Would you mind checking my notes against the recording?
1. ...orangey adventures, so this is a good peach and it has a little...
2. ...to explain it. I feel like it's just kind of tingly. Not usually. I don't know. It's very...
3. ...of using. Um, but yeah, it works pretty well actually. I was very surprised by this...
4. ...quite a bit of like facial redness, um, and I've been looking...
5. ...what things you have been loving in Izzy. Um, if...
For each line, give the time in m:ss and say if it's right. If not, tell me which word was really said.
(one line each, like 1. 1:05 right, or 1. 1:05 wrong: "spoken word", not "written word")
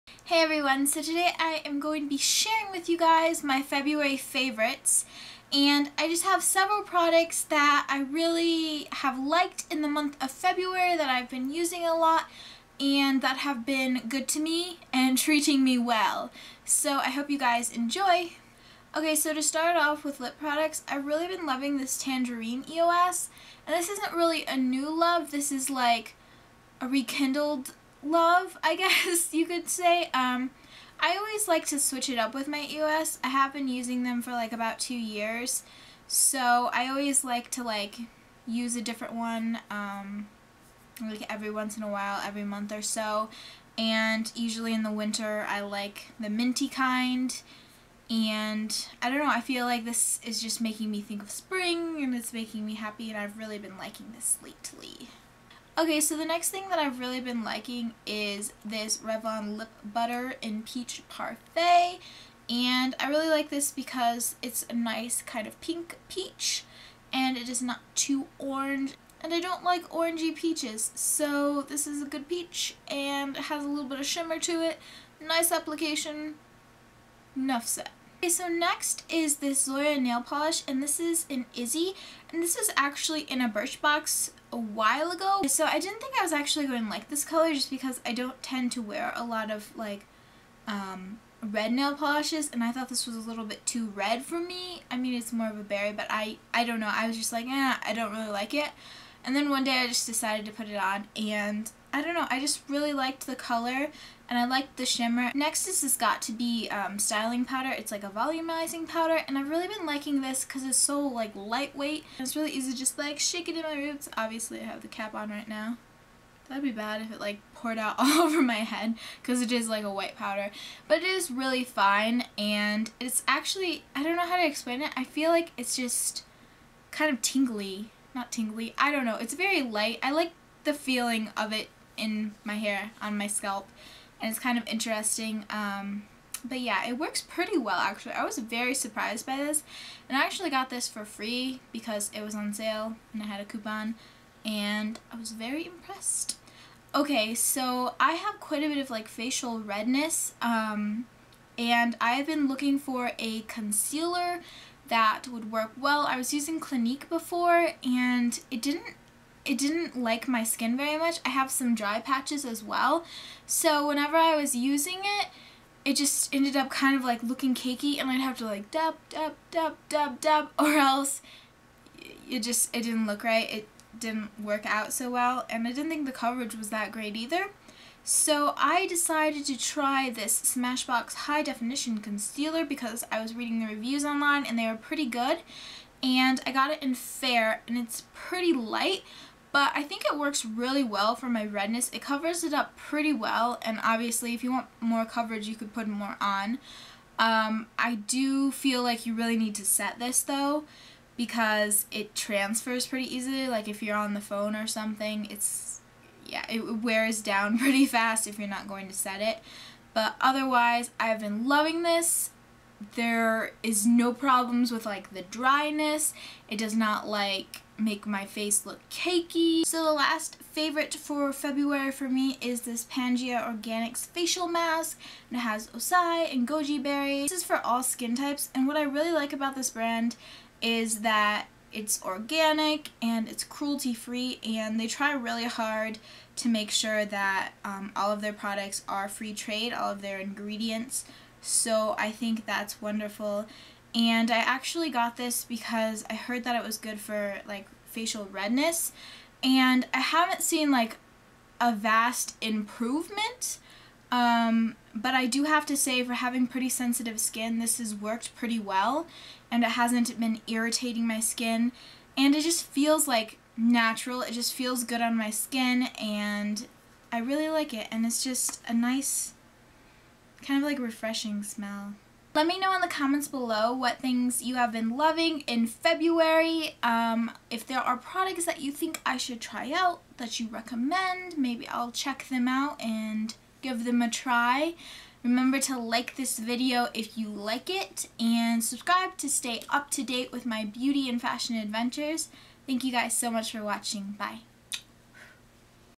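1. 1:09 wrong: "peaches", not "adventures"
2. 2:04 wrong: "tingly", not "usually"
3. 2:14 wrong: "interesting", not "using"
4. 2:28 right
5. 4:33 wrong: "February", not "Izzy".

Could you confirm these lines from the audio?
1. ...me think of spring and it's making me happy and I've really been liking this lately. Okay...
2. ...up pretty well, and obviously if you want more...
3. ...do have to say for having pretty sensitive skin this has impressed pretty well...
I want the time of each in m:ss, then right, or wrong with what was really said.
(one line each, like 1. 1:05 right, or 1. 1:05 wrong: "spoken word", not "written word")
1. 0:50 right
2. 3:12 right
3. 4:15 wrong: "worked", not "impressed".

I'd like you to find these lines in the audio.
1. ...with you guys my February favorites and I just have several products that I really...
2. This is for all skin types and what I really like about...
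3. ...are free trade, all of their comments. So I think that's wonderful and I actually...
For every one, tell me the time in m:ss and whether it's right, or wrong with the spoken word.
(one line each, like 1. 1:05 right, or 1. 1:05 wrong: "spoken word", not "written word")
1. 0:02 right
2. 3:47 right
3. 3:58 wrong: "ingredients", not "comments".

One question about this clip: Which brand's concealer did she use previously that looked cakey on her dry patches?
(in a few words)
Clinique.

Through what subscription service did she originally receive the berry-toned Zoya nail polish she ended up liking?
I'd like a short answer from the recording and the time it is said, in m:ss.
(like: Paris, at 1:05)
Birchbox, at 1:23.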